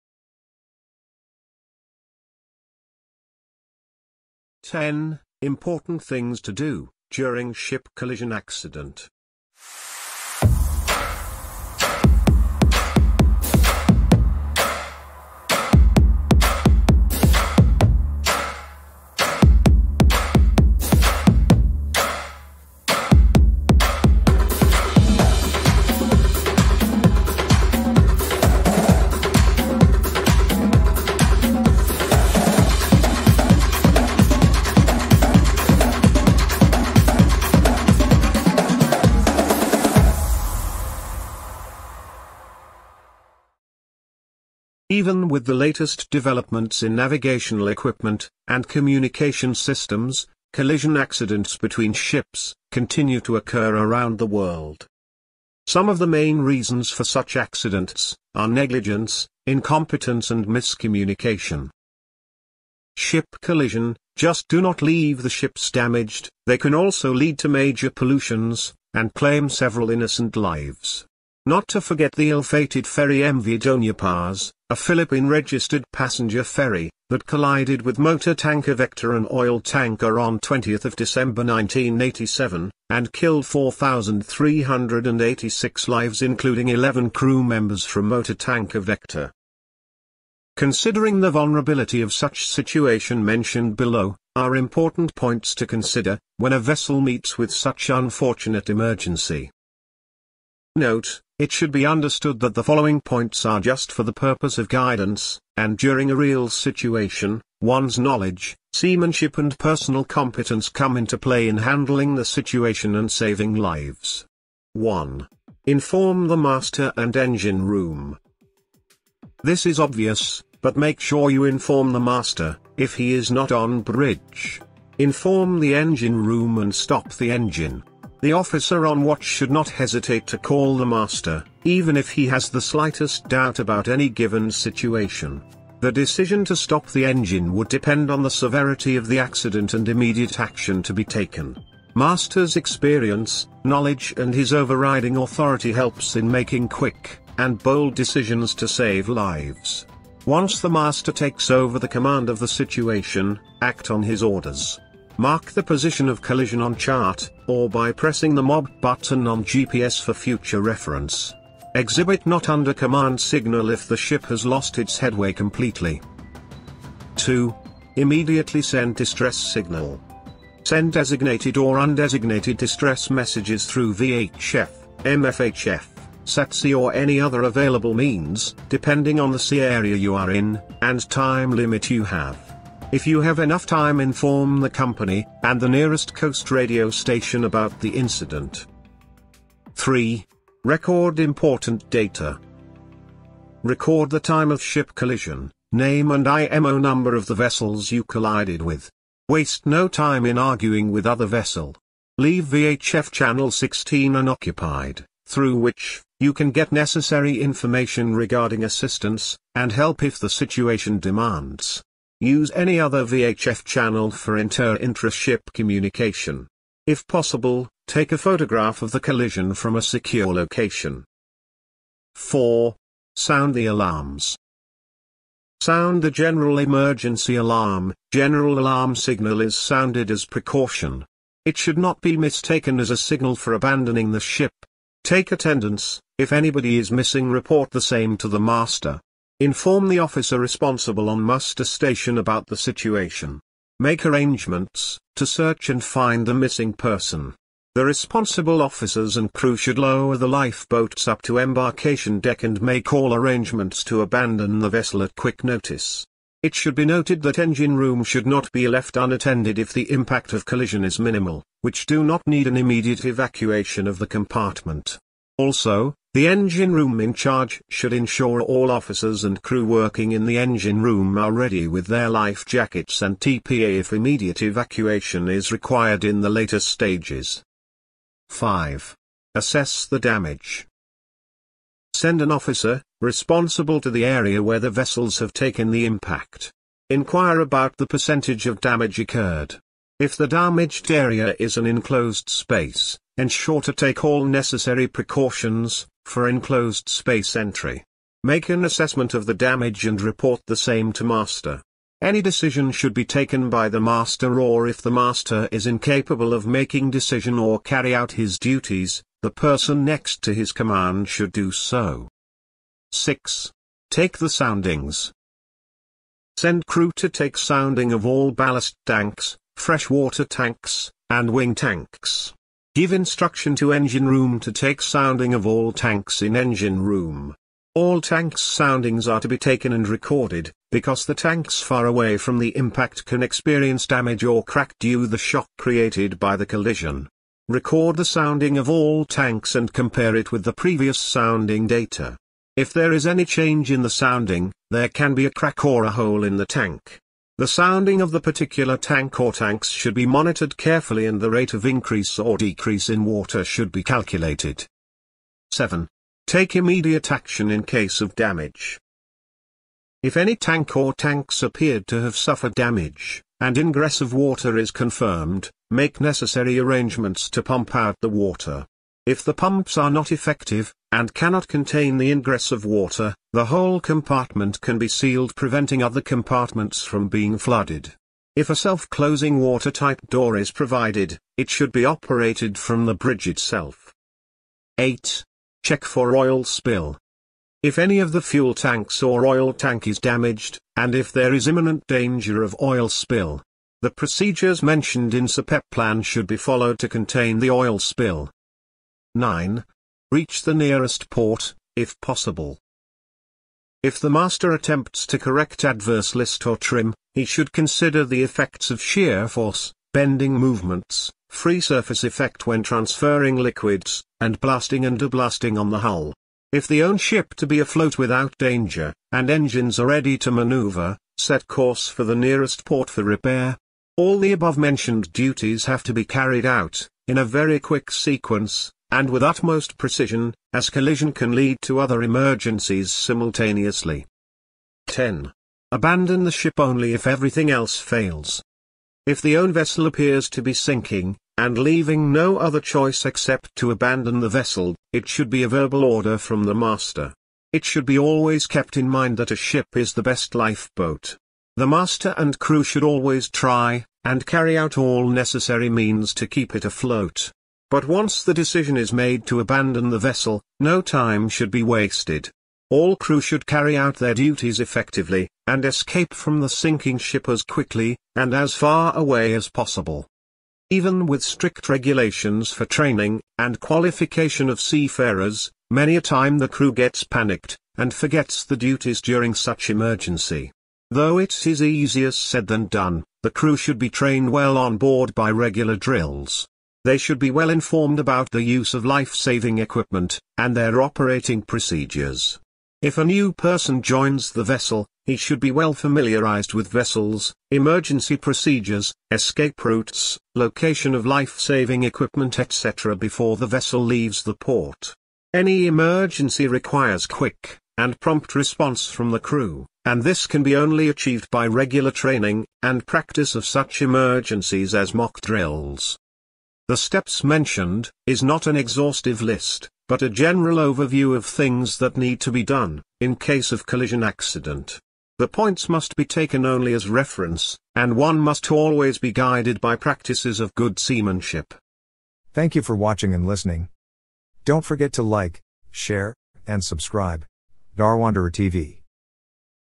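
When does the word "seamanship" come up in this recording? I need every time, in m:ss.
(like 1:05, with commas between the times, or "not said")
1:48, 8:50.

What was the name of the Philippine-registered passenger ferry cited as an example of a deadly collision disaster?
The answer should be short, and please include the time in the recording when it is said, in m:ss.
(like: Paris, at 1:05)
MV Paz, at 1:13.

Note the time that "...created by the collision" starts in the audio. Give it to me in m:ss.
5:35.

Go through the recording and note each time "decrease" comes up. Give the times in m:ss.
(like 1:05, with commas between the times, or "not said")
5:52.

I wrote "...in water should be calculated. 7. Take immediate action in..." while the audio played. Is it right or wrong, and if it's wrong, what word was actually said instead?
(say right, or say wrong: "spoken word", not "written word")
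right.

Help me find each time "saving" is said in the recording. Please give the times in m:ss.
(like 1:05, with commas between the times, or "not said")
1:53, 8:08, 8:21.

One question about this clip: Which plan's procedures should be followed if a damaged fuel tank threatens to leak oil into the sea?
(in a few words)
SOPEP plan.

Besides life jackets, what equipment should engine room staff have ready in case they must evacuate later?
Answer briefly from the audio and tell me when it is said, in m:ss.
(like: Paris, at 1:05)
TPA, at 4:33.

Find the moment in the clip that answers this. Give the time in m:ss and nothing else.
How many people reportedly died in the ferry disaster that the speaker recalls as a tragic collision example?
1:23.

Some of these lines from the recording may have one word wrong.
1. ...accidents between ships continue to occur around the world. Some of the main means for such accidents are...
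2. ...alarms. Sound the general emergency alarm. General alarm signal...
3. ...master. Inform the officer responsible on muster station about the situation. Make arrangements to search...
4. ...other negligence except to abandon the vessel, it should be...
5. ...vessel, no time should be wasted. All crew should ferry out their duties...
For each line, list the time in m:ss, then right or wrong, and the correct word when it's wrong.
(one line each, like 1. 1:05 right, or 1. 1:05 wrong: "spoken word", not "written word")
1. 0:50 wrong: "reasons", not "means"
2. 3:43 right
3. 3:58 right
4. 7:22 wrong: "choice", not "negligence"
5. 7:39 wrong: "carry", not "ferry".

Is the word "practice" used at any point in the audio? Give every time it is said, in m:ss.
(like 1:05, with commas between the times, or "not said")
8:32, 8:49.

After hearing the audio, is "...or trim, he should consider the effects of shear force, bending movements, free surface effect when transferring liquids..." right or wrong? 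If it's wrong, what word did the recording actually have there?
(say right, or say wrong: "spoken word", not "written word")
right.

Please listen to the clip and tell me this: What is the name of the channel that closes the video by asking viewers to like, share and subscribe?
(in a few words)
Darwanderer TV.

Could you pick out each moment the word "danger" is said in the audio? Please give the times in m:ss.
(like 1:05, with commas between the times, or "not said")
6:31, 6:58.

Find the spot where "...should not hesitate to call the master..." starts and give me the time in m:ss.
2:09.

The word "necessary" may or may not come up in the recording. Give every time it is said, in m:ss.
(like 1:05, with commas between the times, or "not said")
3:26, 4:54, 6:05, 7:35.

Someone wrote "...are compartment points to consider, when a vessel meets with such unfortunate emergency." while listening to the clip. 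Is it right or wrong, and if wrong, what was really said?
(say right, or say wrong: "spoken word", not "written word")
wrong: "important", not "compartment".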